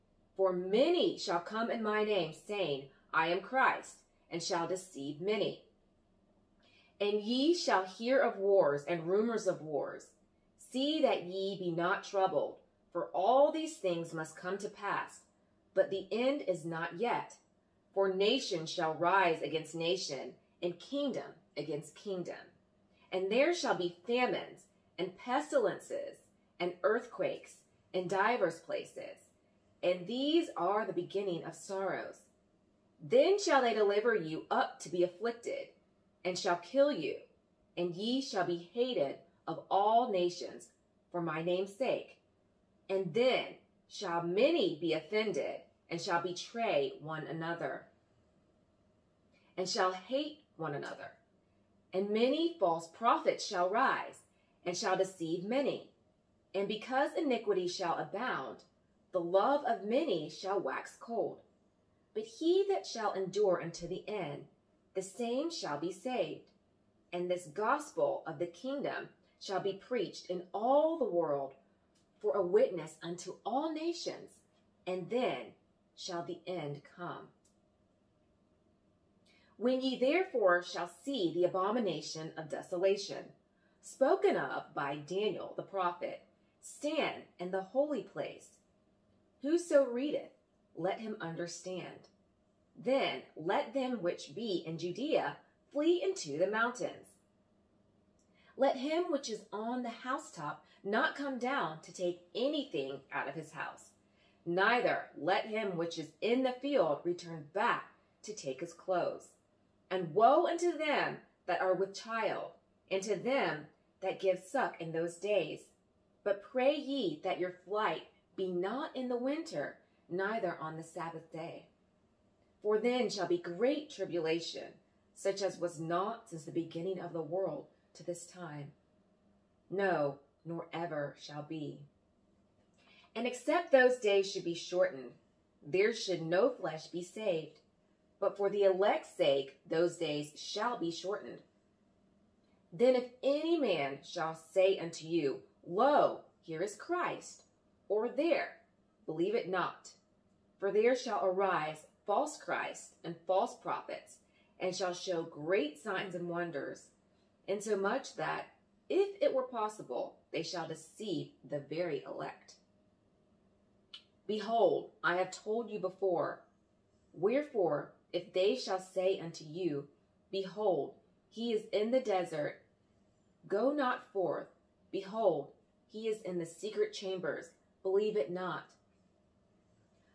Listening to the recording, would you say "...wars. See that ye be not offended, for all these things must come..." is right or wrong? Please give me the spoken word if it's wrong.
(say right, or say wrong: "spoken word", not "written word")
wrong: "troubled", not "offended".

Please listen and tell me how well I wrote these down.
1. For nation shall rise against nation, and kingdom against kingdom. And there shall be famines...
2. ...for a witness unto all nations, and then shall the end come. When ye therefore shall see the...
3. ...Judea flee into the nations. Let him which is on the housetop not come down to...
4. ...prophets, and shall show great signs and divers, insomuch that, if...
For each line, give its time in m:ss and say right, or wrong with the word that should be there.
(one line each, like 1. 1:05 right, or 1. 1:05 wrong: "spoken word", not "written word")
1. 0:17 right
2. 1:12 right
3. 1:34 wrong: "mountains", not "nations"
4. 2:33 wrong: "wonders", not "divers".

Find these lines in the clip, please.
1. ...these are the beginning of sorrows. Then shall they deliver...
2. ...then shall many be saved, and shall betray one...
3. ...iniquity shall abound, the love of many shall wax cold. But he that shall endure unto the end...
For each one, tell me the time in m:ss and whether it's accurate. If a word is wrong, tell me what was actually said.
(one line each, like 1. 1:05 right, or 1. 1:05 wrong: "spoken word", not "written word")
1. 0:30 right
2. 0:43 wrong: "offended", not "saved"
3. 0:57 right.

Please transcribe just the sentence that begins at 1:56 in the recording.
But pray ye that your flight be not in the winter, neither on the Sabbath day.